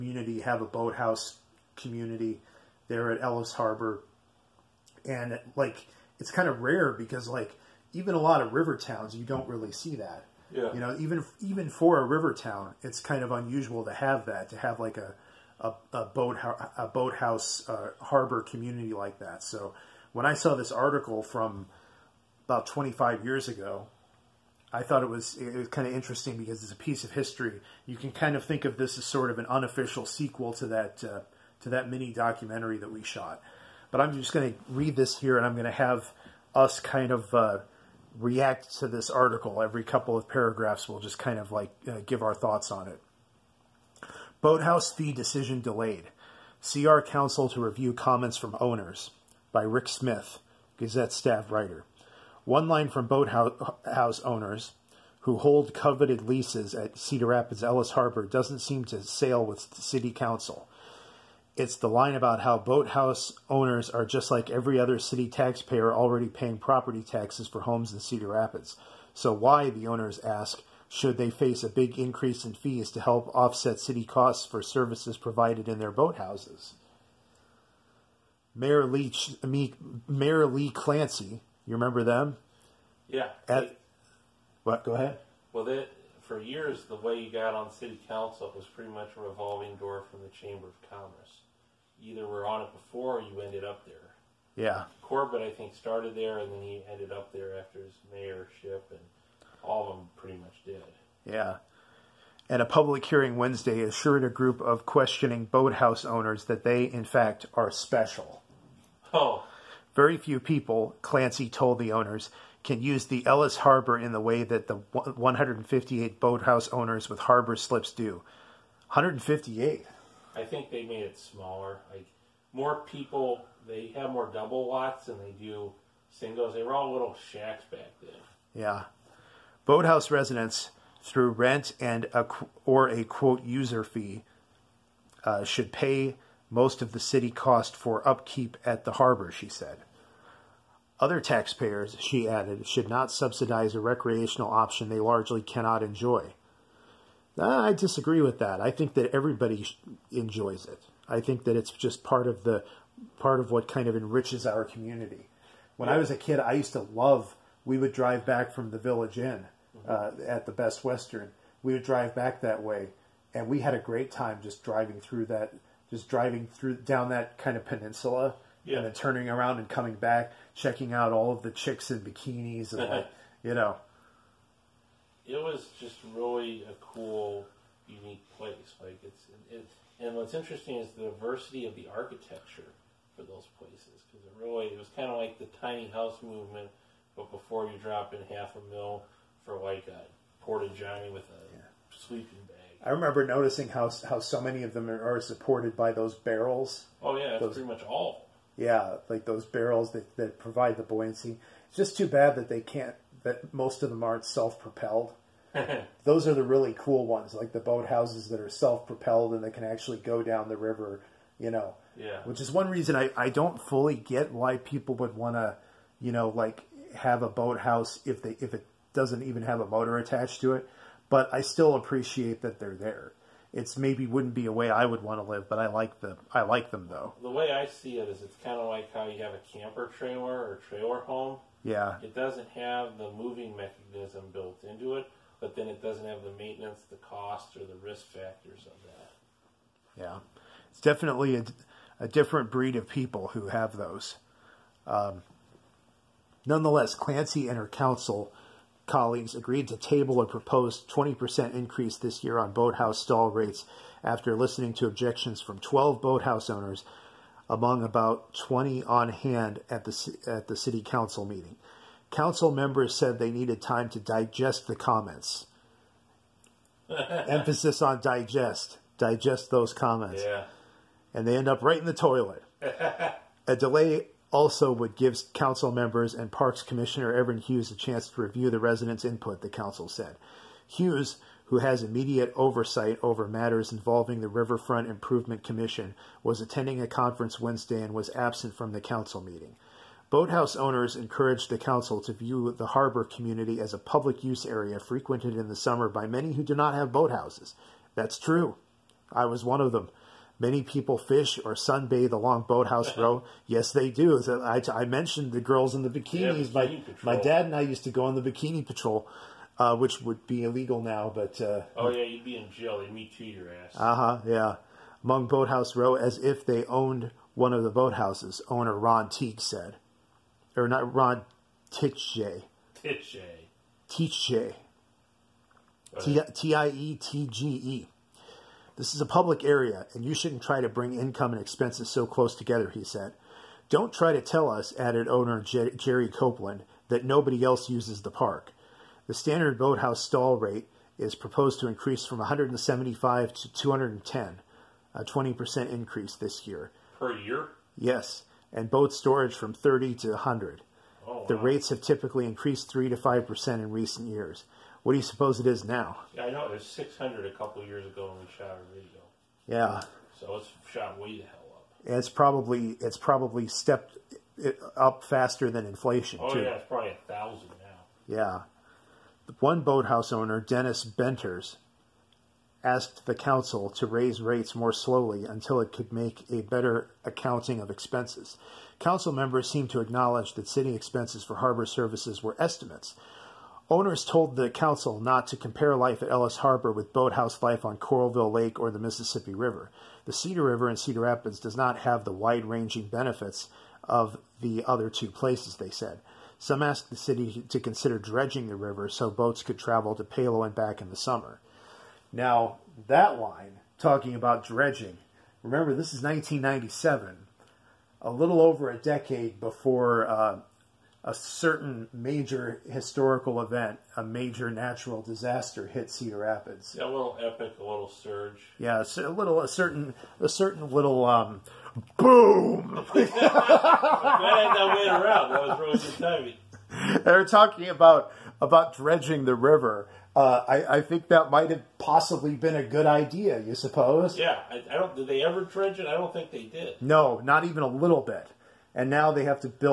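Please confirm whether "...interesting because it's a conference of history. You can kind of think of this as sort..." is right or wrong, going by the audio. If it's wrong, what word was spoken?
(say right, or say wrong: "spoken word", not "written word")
wrong: "piece", not "conference".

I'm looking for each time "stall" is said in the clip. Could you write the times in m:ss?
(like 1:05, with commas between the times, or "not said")
4:13, 5:40.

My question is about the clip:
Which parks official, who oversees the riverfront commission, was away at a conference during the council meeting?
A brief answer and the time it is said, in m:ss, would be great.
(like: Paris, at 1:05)
Evan Hughes, at 4:37.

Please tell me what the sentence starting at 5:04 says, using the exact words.
I, I mentioned the girls in the bikinis.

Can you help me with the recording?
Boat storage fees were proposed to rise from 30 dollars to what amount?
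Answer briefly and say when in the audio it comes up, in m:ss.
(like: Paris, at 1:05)
100, at 5:50.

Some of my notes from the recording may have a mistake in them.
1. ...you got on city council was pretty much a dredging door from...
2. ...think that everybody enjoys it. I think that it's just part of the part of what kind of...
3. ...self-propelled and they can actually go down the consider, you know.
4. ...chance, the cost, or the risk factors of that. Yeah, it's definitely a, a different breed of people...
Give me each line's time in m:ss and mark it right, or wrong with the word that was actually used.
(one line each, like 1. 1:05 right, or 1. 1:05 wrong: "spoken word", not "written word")
1. 1:27 wrong: "revolving", not "dredging"
2. 2:28 right
3. 3:28 wrong: "river", not "consider"
4. 3:56 wrong: "maintenance", not "chance".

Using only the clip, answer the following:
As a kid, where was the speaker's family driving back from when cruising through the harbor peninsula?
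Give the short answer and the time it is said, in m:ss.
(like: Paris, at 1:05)
the village inn, at 2:38.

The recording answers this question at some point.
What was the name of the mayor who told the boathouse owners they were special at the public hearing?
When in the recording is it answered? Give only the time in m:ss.
1:20.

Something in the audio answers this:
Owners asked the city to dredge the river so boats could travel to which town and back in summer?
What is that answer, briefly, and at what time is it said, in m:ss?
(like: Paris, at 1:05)
Palo, at 6:40.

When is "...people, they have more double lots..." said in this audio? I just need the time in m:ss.
2:02.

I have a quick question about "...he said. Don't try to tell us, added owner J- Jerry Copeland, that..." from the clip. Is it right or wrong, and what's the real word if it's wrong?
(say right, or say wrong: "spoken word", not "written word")
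right.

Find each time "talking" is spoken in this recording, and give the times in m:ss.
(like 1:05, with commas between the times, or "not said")
6:43, 7:07.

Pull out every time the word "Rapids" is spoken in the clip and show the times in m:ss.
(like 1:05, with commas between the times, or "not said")
0:57, 1:08, 6:31, 6:56.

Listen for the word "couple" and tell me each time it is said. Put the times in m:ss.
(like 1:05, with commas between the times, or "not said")
0:39, 5:57.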